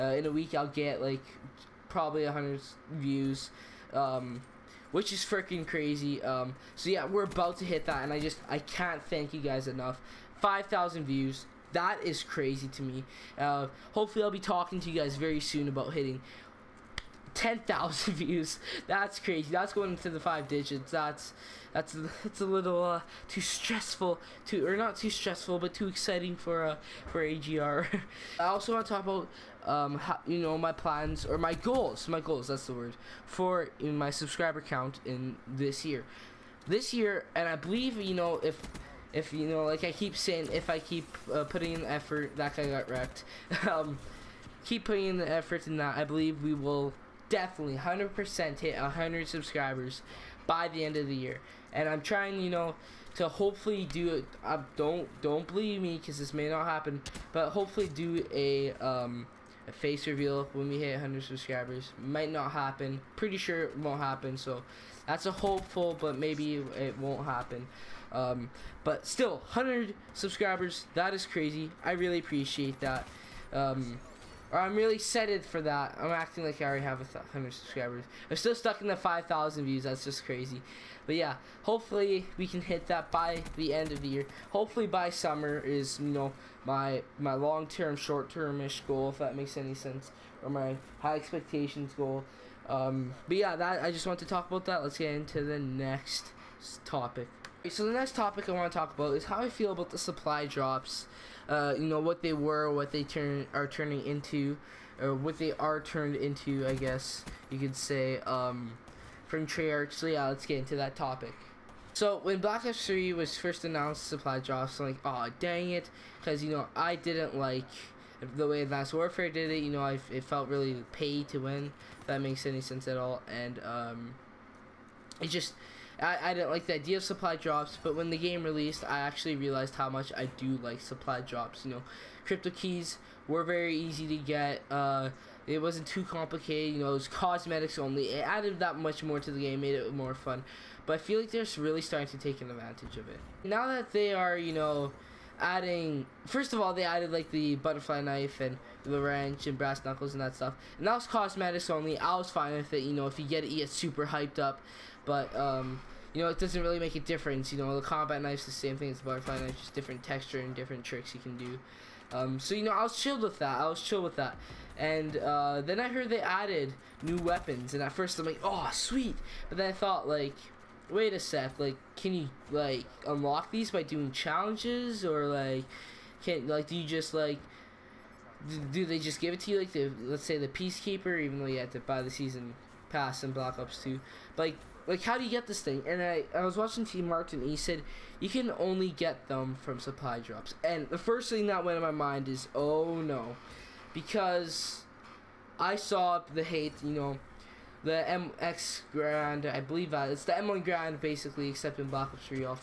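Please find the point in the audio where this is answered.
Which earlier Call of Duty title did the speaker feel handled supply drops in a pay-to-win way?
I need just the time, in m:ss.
1:58.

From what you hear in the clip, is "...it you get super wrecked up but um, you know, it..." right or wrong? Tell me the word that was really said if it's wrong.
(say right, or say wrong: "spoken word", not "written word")
wrong: "hyped", not "wrecked".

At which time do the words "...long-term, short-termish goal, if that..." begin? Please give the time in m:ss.
1:27.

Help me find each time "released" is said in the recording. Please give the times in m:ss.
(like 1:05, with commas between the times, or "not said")
2:08.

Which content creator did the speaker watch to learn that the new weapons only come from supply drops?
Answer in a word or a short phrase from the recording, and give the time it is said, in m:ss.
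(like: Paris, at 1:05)
TmarTn, at 3:06.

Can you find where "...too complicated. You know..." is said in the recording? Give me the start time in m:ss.
2:15.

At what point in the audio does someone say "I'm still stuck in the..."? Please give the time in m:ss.
1:18.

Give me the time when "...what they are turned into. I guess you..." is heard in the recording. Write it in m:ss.
1:45.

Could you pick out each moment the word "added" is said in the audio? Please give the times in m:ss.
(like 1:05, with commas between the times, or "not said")
2:18, 2:26, 2:46.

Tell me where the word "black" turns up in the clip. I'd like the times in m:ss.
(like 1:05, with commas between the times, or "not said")
1:52, 3:03, 3:21.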